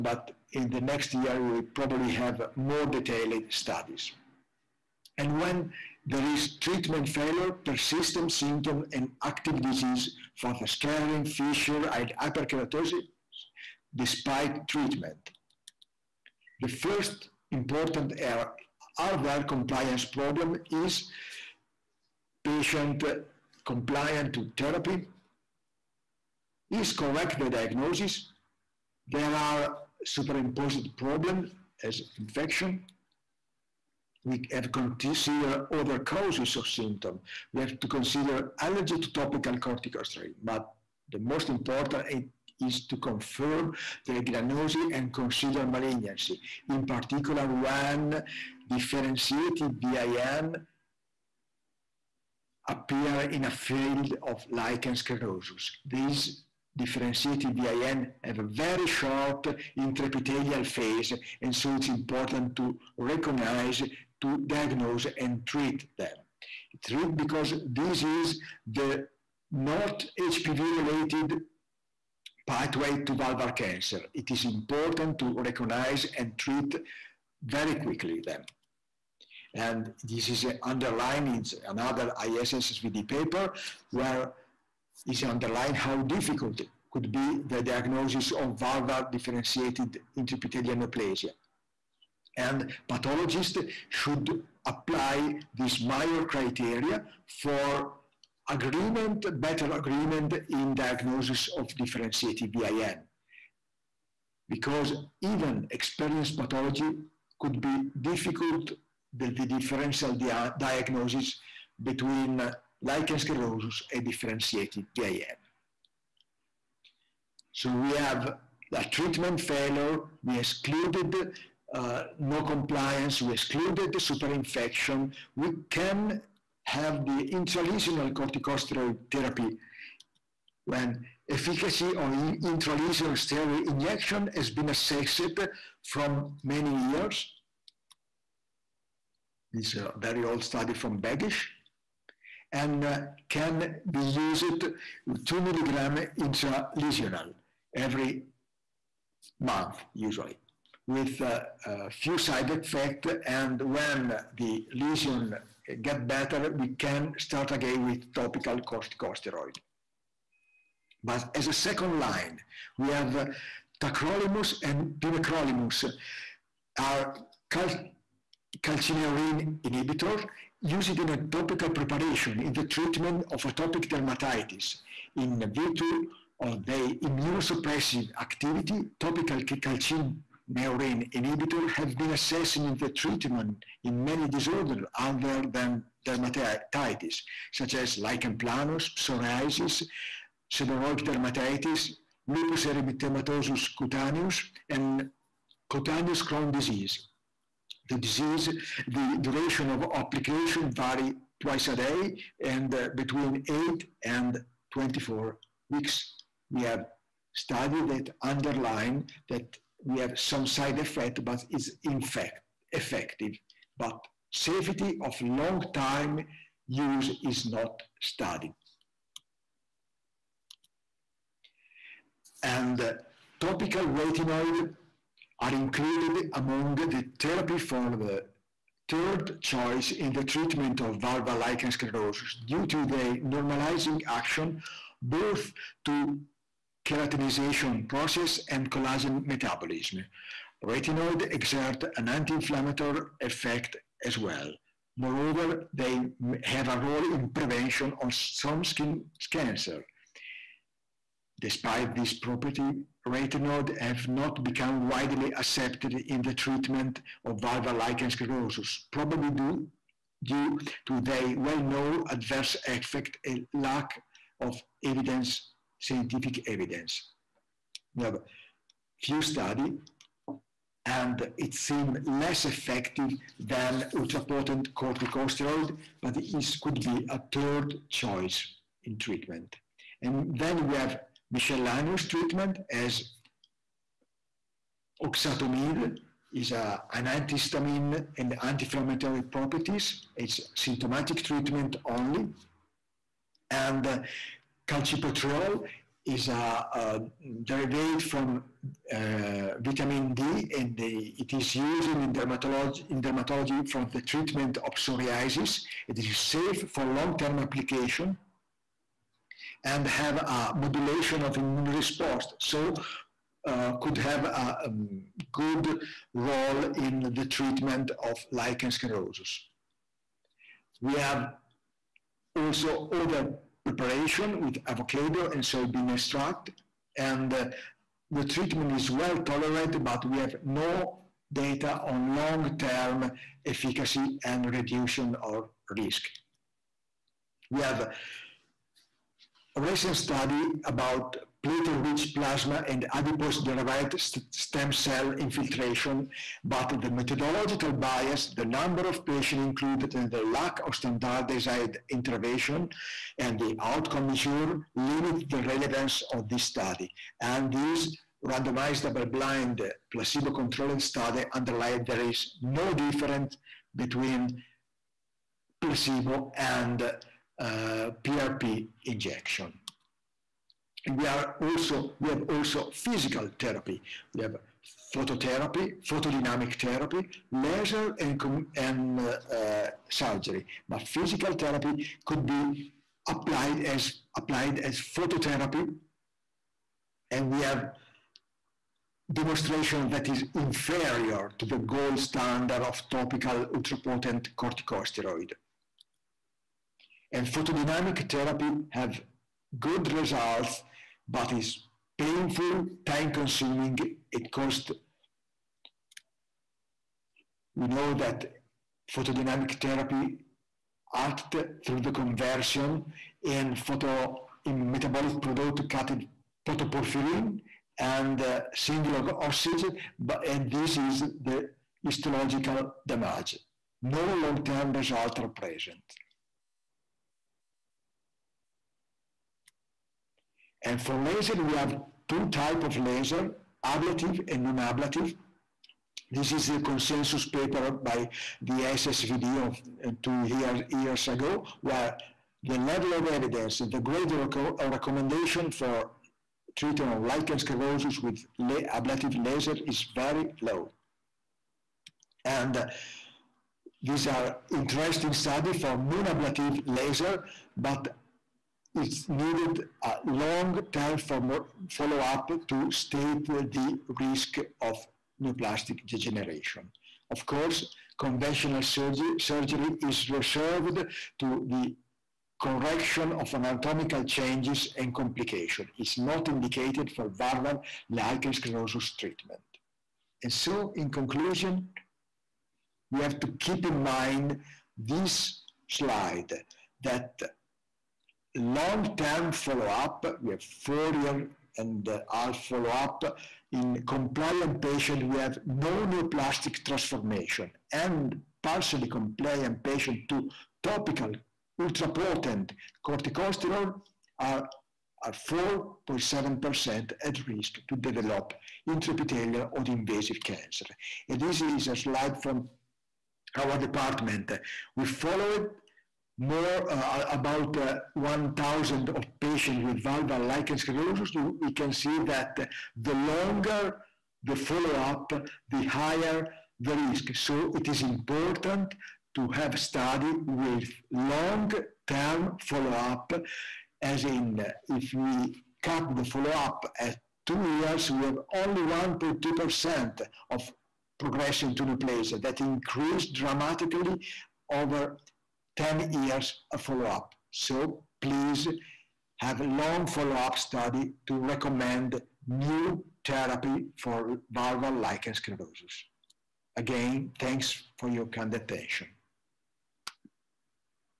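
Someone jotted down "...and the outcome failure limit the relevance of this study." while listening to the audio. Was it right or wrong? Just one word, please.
wrong.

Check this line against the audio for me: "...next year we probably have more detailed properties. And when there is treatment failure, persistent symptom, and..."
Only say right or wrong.
wrong.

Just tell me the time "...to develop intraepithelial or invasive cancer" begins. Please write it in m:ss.
8:27.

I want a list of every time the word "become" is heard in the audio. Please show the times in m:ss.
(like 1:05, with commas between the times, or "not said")
4:14.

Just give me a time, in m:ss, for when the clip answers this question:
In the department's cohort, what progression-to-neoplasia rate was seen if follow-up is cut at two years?
8:58.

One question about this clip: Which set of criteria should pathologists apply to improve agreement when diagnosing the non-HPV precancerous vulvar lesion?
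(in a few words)
Meyer criteria.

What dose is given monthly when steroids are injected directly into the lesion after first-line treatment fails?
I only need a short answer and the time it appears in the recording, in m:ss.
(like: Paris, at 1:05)
2 milligrams, at 2:25.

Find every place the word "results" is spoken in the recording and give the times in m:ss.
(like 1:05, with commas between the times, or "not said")
6:39, 7:04.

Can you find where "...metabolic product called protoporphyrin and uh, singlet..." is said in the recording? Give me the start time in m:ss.
6:54.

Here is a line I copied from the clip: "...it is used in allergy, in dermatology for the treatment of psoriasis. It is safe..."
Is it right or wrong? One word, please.
wrong.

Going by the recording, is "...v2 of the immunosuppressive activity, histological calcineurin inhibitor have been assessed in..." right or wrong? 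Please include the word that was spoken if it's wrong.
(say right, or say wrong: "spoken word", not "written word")
wrong: "topical", not "histological".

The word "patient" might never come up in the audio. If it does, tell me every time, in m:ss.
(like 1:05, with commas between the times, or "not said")
0:22, 5:49, 8:14, 8:19, 8:39.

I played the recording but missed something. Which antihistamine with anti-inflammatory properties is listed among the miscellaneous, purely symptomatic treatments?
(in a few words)
oxatomide.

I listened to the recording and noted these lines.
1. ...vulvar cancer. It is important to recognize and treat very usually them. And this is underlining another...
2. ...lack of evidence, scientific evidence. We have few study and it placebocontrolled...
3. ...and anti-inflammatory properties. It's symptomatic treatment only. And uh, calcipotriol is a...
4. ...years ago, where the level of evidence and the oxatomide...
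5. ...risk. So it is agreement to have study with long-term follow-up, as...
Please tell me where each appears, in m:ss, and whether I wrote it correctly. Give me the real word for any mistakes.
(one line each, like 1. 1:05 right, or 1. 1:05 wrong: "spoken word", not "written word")
1. 1:13 wrong: "quickly", not "usually"
2. 4:23 wrong: "seemed", not "placebocontrolled"
3. 4:48 right
4. 7:20 wrong: "grade", not "oxatomide"
5. 8:46 wrong: "important", not "agreement".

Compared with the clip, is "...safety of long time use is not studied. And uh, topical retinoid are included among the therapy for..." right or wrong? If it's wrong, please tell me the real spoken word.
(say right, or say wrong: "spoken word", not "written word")
right.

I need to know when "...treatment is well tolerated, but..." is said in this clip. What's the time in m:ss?
5:28.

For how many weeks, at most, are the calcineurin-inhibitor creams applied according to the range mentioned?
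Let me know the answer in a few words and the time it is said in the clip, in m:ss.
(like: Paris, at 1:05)
24, at 3:24.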